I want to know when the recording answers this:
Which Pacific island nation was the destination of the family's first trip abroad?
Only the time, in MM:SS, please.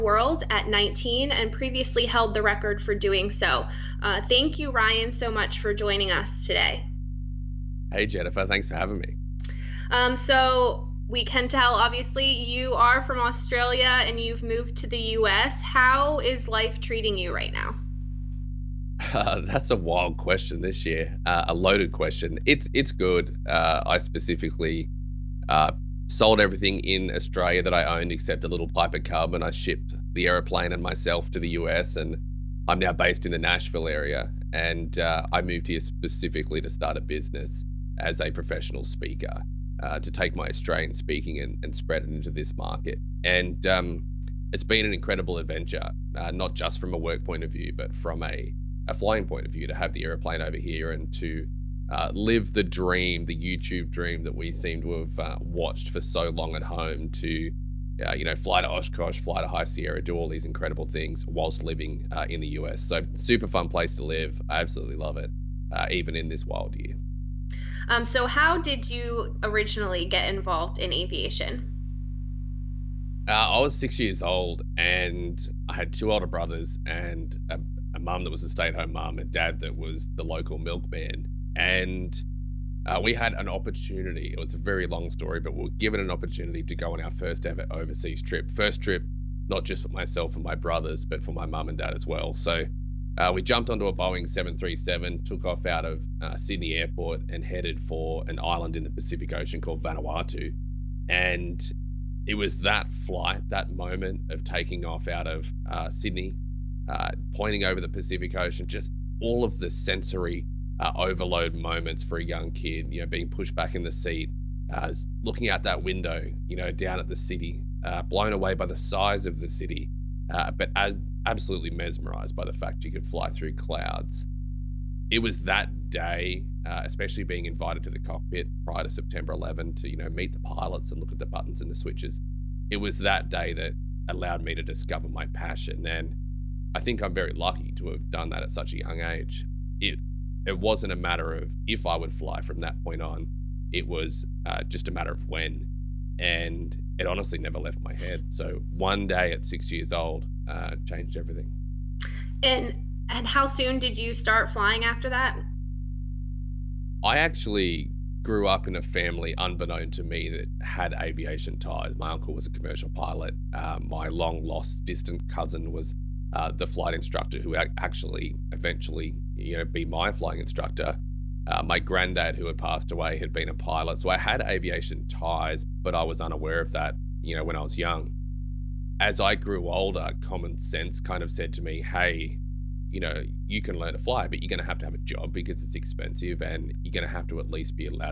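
01:39.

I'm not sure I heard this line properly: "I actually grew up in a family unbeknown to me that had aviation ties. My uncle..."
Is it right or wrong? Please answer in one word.
right.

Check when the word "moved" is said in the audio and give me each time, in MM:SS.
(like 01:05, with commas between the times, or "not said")
00:14, 00:35.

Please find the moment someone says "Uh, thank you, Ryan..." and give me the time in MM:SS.
00:04.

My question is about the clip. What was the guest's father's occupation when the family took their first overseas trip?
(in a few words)
Milkman.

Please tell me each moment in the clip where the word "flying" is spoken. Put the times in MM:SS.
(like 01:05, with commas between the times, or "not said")
00:48, 02:34, 02:50.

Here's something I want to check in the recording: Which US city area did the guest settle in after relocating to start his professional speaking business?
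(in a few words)
Nashville.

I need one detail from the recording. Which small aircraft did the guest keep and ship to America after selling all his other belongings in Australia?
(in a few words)
Piper Cub.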